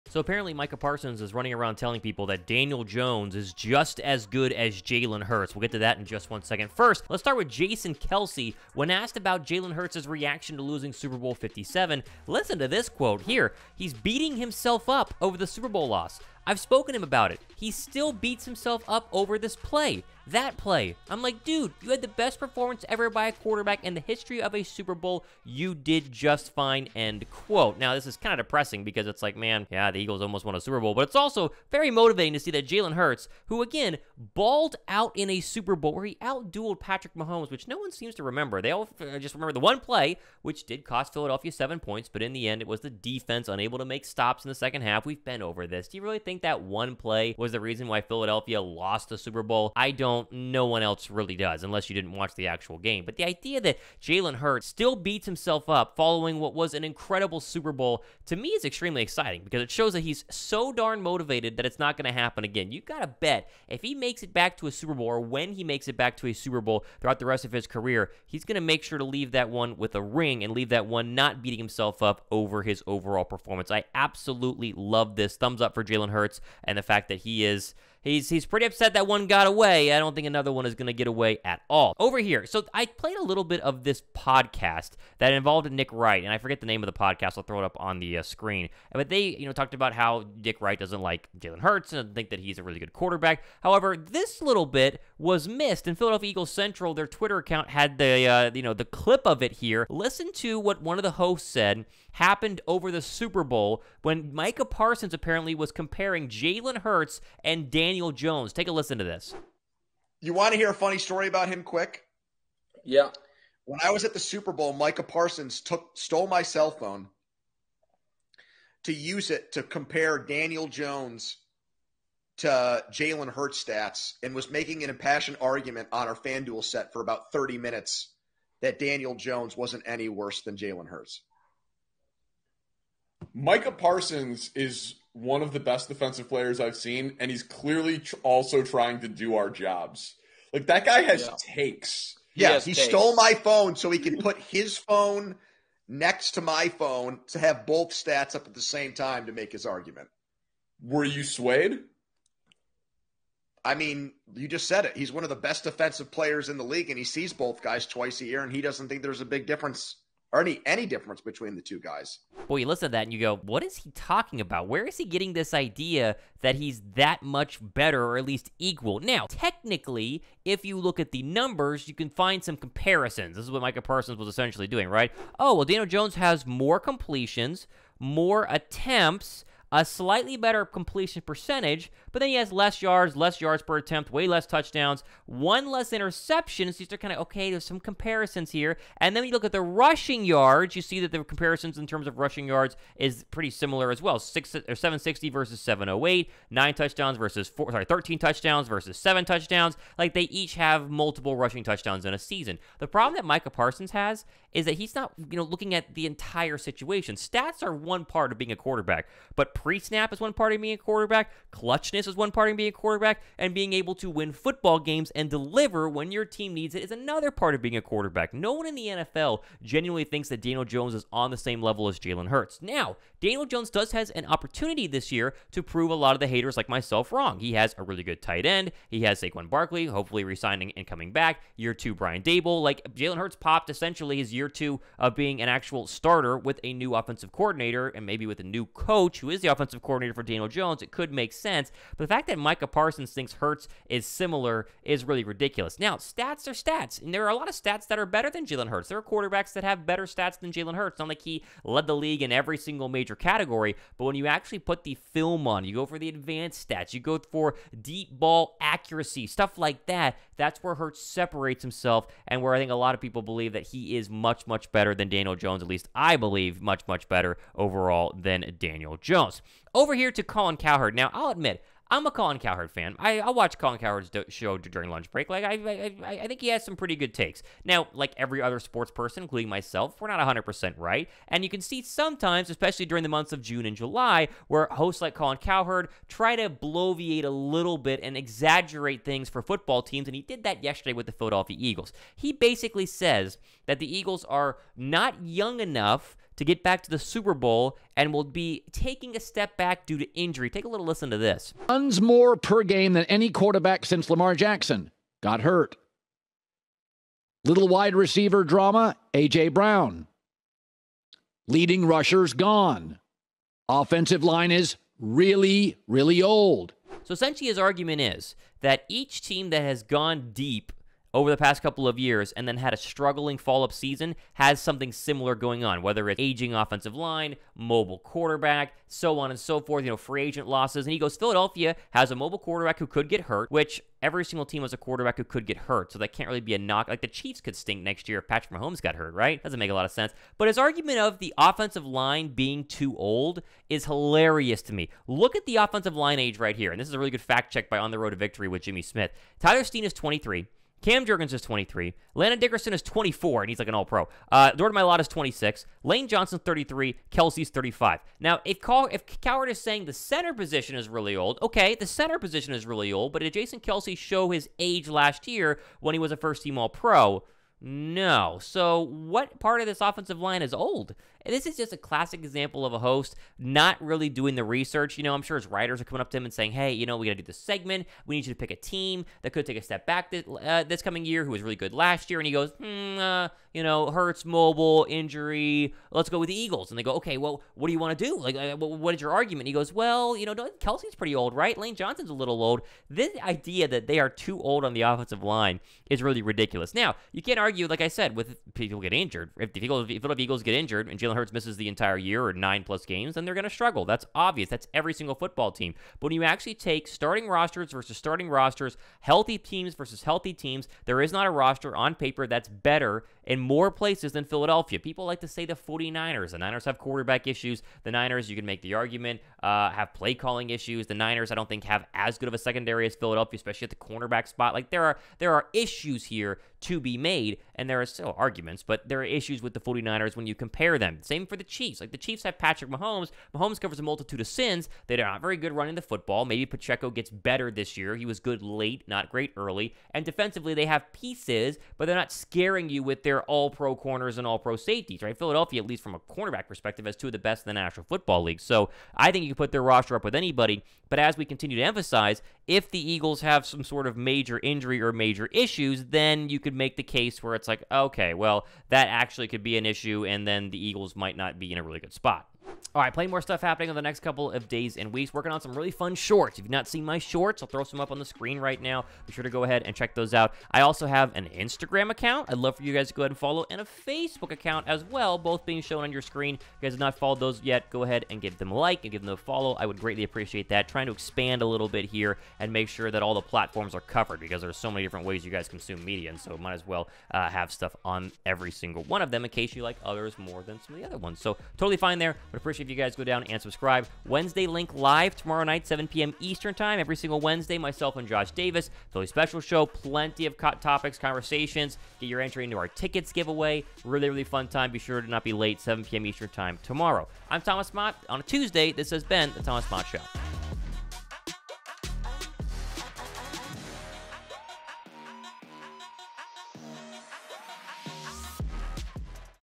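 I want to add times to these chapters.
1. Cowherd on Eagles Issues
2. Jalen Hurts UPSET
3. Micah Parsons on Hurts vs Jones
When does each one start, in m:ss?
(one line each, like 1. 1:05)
1. 4:29
2. 0:10
3. 1:23.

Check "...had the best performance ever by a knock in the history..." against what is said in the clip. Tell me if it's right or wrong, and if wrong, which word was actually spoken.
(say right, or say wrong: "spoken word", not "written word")
wrong: "quarterback", not "knock".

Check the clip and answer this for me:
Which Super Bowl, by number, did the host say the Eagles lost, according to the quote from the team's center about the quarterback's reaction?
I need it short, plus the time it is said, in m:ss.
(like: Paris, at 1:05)
57, at 0:10.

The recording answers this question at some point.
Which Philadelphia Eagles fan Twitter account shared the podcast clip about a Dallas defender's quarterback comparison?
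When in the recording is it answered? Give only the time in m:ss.
1:35.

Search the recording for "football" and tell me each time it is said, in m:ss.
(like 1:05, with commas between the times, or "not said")
3:34, 4:49, 6:45, 7:15, 7:27.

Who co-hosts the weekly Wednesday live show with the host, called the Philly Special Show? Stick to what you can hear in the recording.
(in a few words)
Josh Davis.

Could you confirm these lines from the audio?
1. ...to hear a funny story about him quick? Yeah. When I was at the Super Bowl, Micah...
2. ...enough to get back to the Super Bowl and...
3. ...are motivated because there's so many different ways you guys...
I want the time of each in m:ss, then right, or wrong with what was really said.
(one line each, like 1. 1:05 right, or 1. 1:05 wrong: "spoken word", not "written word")
1. 1:50 right
2. 4:55 right
3. 8:03 wrong: "covered", not "motivated".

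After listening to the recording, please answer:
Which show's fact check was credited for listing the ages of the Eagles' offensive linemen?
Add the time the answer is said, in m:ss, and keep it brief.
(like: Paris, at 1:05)
On the Road to Victory, at 5:47.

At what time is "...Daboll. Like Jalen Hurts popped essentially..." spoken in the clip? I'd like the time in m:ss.
3:52.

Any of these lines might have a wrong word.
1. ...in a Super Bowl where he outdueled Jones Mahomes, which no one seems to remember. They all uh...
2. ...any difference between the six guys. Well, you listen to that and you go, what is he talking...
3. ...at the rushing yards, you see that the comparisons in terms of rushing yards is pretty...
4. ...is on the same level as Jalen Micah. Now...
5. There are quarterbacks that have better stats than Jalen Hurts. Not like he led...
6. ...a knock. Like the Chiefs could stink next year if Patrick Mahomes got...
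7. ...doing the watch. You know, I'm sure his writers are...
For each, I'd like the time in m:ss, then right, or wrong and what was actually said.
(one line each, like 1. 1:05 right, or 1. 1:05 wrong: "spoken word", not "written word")
1. 0:35 wrong: "Patrick", not "Jones"
2. 2:40 wrong: "two", not "six"
3. 3:09 right
4. 3:40 wrong: "Hurts", not "Micah"
5. 4:08 right
6. 5:36 right
7. 6:14 wrong: "research", not "watch".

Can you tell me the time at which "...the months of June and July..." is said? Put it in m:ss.
4:43.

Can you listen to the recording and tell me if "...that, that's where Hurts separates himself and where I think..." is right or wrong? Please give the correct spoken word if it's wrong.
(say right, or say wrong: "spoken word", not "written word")
right.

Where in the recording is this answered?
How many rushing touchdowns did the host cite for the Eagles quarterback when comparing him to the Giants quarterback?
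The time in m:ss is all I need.
3:17.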